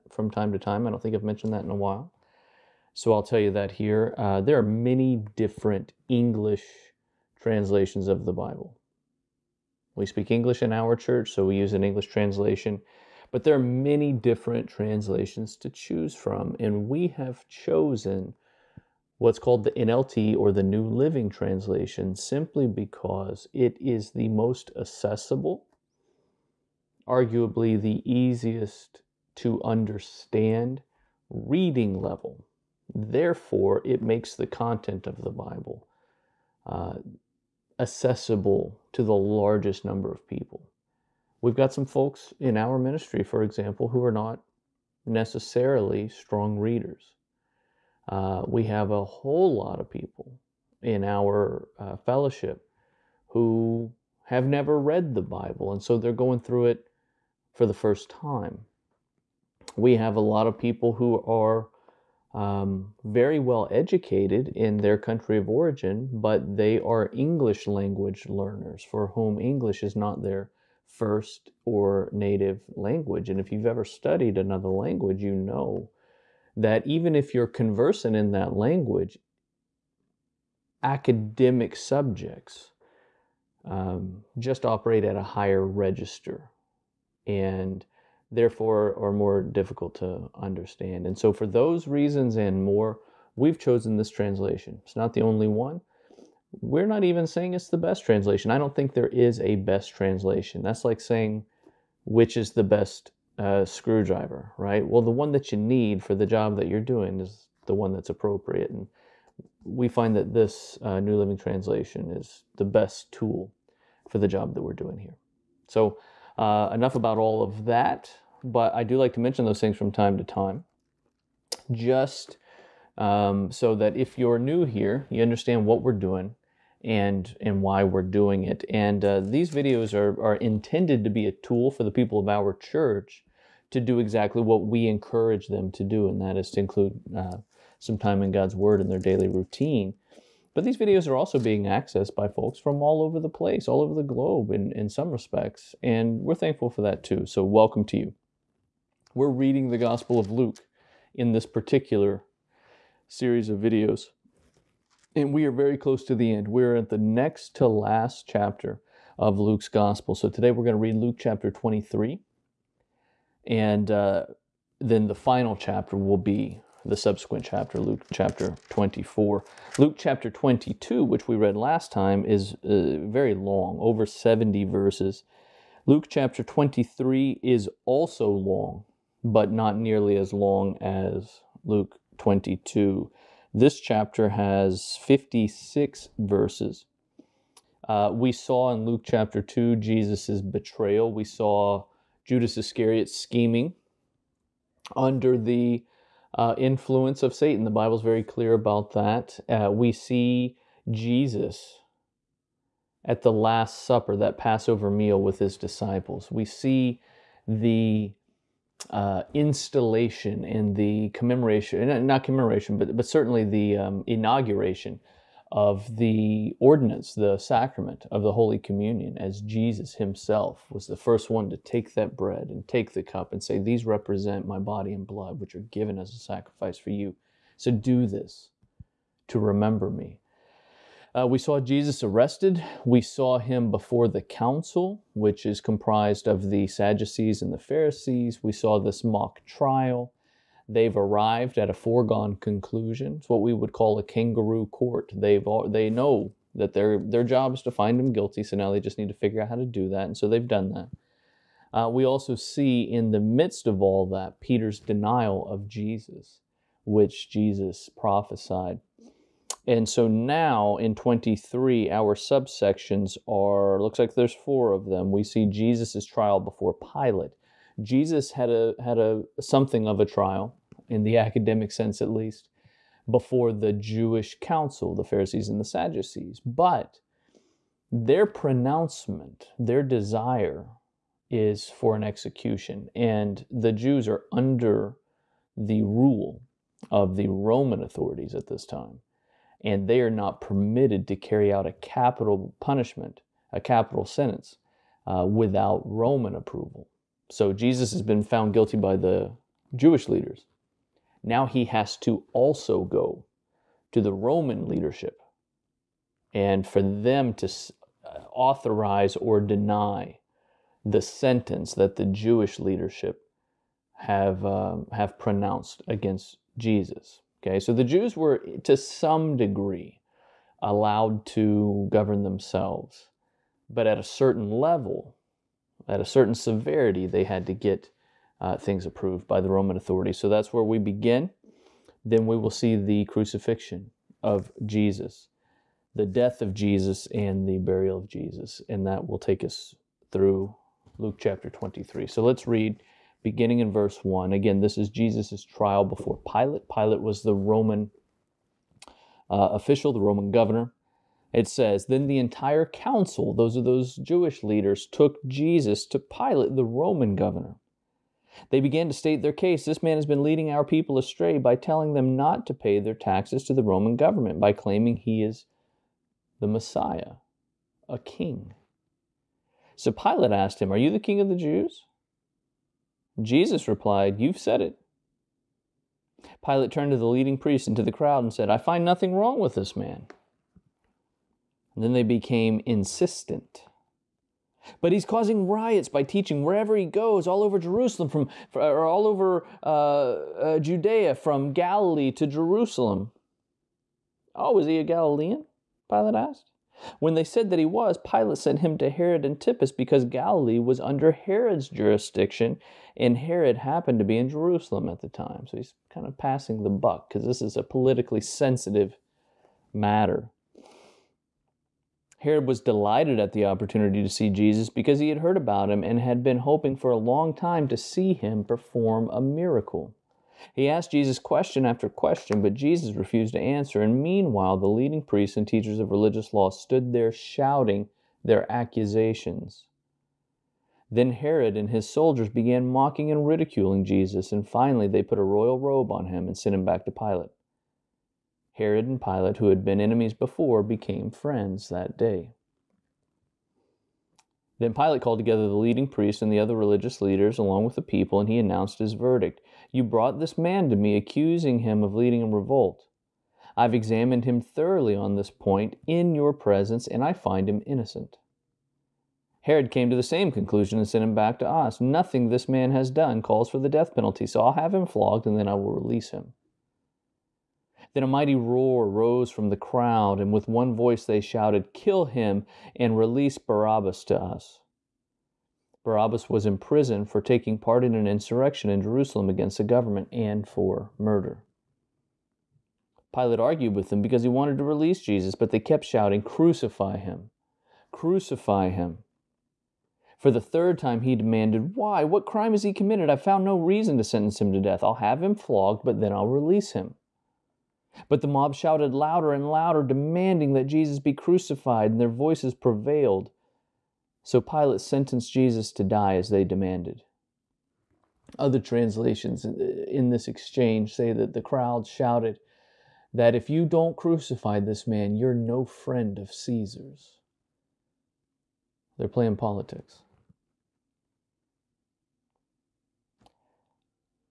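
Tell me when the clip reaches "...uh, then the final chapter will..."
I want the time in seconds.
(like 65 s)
163 s.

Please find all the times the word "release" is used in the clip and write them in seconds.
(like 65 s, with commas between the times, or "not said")
465 s, 472 s, 484 s, 496 s.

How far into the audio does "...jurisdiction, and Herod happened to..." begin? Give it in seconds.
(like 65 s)
401 s.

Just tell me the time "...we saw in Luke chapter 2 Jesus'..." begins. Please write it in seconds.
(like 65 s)
188 s.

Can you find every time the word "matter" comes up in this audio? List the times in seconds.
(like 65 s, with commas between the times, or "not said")
409 s.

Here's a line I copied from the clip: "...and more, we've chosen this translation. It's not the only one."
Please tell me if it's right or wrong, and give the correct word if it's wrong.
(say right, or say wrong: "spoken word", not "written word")
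right.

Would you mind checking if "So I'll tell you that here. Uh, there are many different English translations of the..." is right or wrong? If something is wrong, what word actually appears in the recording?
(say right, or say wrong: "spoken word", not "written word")
right.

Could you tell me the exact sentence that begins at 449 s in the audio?
You brought this man to me, accusing him of leading a revolt.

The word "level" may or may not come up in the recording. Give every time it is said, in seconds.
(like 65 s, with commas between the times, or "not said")
31 s, 324 s.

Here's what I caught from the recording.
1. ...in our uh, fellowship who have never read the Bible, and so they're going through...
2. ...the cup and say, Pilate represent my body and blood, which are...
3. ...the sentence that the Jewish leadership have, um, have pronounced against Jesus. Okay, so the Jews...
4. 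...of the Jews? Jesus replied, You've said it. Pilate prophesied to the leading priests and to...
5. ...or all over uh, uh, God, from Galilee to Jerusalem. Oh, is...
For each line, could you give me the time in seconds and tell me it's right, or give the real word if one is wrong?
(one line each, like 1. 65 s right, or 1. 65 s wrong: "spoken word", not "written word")
1. 50 s right
2. 222 s wrong: "These", not "Pilate"
3. 310 s right
4. 371 s wrong: "turned", not "prophesied"
5. 388 s wrong: "Judea", not "God".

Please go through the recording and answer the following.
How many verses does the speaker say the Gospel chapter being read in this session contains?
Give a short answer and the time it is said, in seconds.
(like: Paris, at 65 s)
56, at 185 s.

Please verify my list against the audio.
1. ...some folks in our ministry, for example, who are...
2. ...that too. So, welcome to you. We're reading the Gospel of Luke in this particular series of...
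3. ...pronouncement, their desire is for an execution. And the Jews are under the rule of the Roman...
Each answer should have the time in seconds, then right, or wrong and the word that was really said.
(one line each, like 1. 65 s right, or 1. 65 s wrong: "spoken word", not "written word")
1. 41 s right
2. 146 s right
3. 278 s right.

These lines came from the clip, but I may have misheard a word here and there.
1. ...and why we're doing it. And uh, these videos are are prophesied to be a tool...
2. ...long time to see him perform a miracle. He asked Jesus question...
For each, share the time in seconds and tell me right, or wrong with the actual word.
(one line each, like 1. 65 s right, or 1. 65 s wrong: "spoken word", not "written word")
1. 127 s wrong: "intended", not "prophesied"
2. 416 s right.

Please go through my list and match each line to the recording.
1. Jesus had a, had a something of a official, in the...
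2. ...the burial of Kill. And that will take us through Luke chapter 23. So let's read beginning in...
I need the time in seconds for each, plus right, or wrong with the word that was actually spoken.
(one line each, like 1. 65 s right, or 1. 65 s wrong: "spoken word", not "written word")
1. 267 s wrong: "trial", not "official"
2. 337 s wrong: "Jesus", not "Kill".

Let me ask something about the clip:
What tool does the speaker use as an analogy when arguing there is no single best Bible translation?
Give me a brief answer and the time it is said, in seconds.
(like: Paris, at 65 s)
screwdriver, at 103 s.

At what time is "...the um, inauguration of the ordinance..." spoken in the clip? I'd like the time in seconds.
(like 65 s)
213 s.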